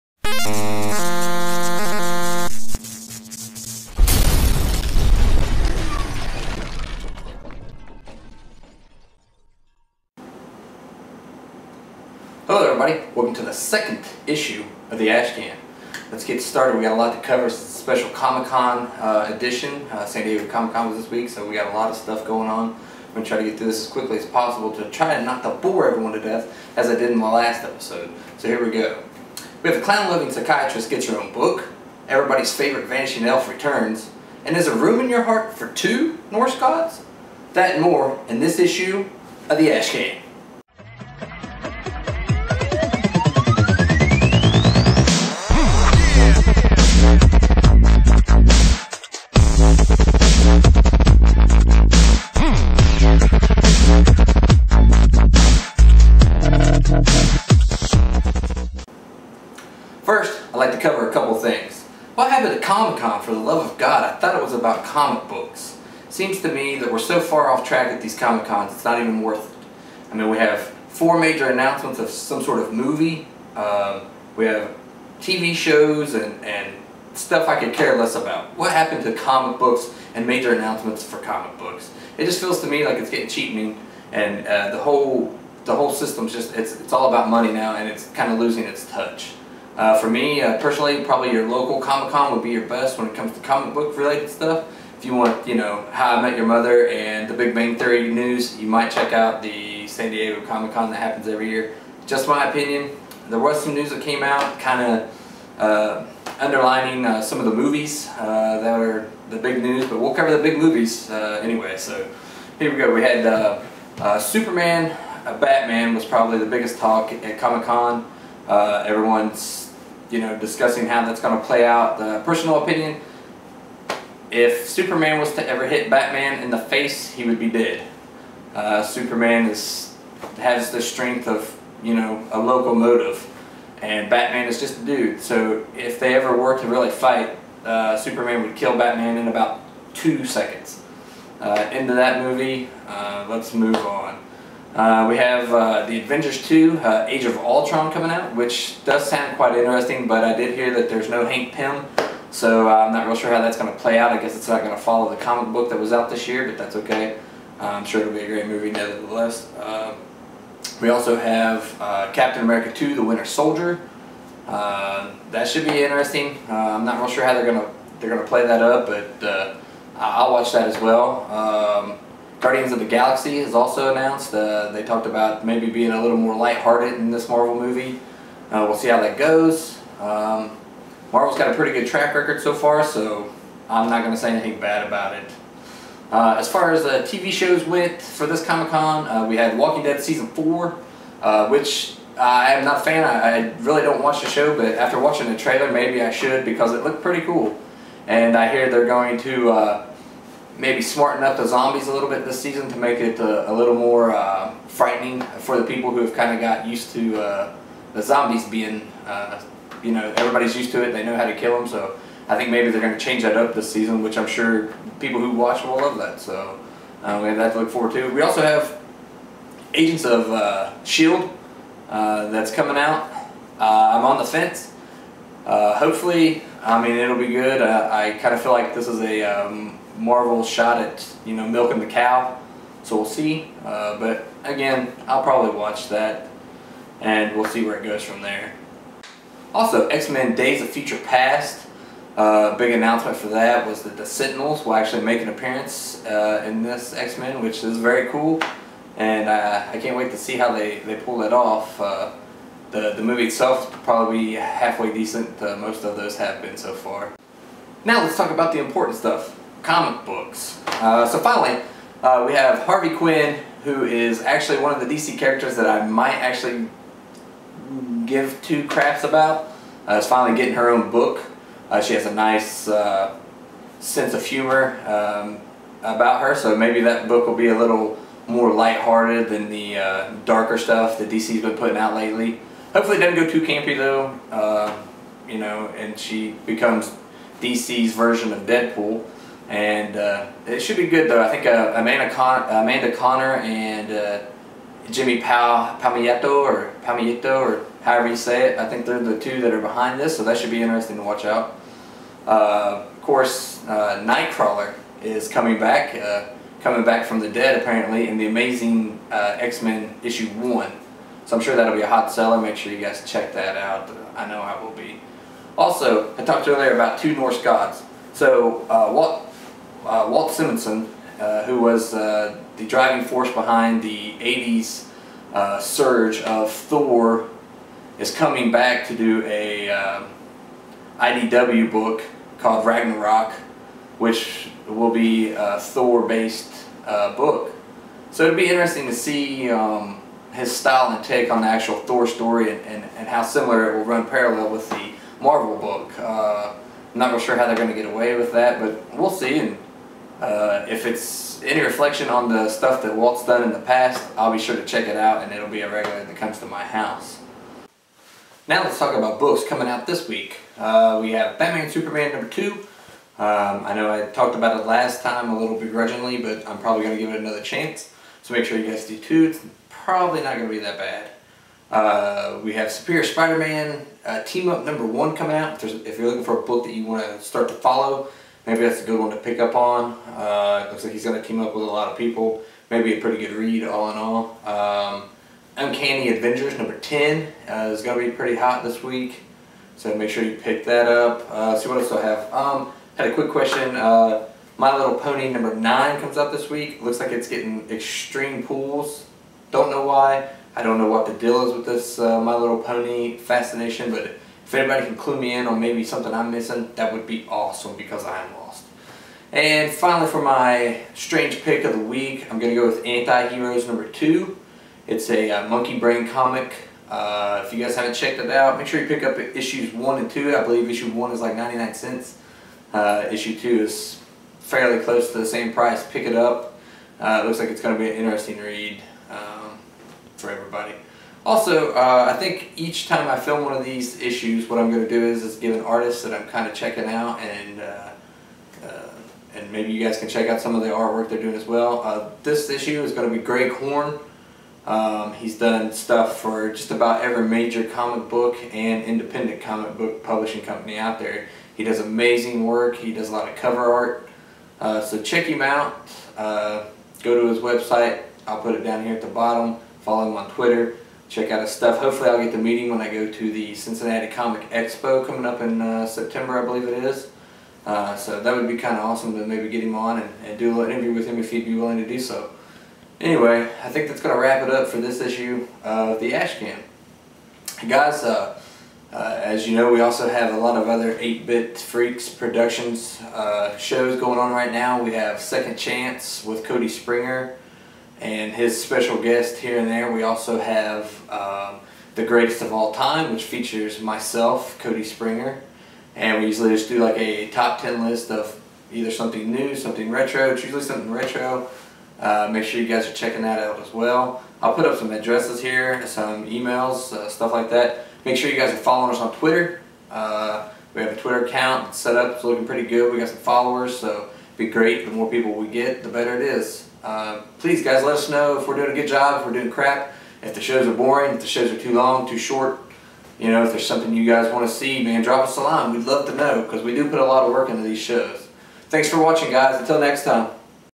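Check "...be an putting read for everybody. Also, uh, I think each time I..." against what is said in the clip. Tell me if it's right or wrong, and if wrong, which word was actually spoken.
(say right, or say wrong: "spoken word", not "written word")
wrong: "interesting", not "putting".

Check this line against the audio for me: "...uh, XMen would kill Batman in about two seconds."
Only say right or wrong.
wrong.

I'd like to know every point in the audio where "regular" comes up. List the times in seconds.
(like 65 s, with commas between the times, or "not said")
355 s.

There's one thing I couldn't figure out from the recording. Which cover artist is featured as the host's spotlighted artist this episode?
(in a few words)
Greg Horn.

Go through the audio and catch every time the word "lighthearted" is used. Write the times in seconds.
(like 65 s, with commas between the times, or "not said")
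176 s, 278 s.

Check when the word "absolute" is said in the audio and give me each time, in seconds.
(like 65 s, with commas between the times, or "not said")
not said.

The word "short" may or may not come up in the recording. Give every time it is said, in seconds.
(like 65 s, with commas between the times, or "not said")
522 s.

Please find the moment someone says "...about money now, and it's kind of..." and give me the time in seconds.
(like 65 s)
87 s.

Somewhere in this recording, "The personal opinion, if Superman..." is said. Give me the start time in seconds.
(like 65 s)
121 s.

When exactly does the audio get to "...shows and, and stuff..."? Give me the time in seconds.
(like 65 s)
75 s.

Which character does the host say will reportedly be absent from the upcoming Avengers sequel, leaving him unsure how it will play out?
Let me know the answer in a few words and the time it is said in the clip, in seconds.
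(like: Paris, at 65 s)
Hank Pym, at 151 s.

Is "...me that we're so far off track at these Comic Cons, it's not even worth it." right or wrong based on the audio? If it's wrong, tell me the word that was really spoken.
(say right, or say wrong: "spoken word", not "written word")
right.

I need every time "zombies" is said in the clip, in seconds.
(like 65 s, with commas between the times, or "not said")
201 s, 208 s.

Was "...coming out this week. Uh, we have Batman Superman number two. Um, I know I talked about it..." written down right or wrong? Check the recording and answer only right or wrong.
right.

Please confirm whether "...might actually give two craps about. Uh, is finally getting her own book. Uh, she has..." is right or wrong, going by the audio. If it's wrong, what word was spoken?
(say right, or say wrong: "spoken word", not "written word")
right.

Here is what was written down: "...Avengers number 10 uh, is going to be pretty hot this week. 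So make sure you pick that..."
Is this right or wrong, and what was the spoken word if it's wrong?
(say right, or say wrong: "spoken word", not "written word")
right.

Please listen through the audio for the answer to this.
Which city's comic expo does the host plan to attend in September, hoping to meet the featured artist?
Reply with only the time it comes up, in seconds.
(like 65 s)
463 s.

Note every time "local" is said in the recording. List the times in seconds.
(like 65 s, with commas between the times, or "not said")
91 s.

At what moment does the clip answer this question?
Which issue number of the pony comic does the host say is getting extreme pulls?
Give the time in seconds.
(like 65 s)
395 s.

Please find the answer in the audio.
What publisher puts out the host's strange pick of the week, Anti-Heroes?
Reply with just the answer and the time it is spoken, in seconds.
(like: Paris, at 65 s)
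Monkeybrain, at 415 s.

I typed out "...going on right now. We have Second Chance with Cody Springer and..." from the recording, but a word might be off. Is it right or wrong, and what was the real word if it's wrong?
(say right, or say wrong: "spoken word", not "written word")
right.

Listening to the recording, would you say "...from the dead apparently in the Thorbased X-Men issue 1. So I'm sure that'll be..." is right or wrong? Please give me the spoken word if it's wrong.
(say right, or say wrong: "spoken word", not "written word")
wrong: "Amazing", not "Thorbased".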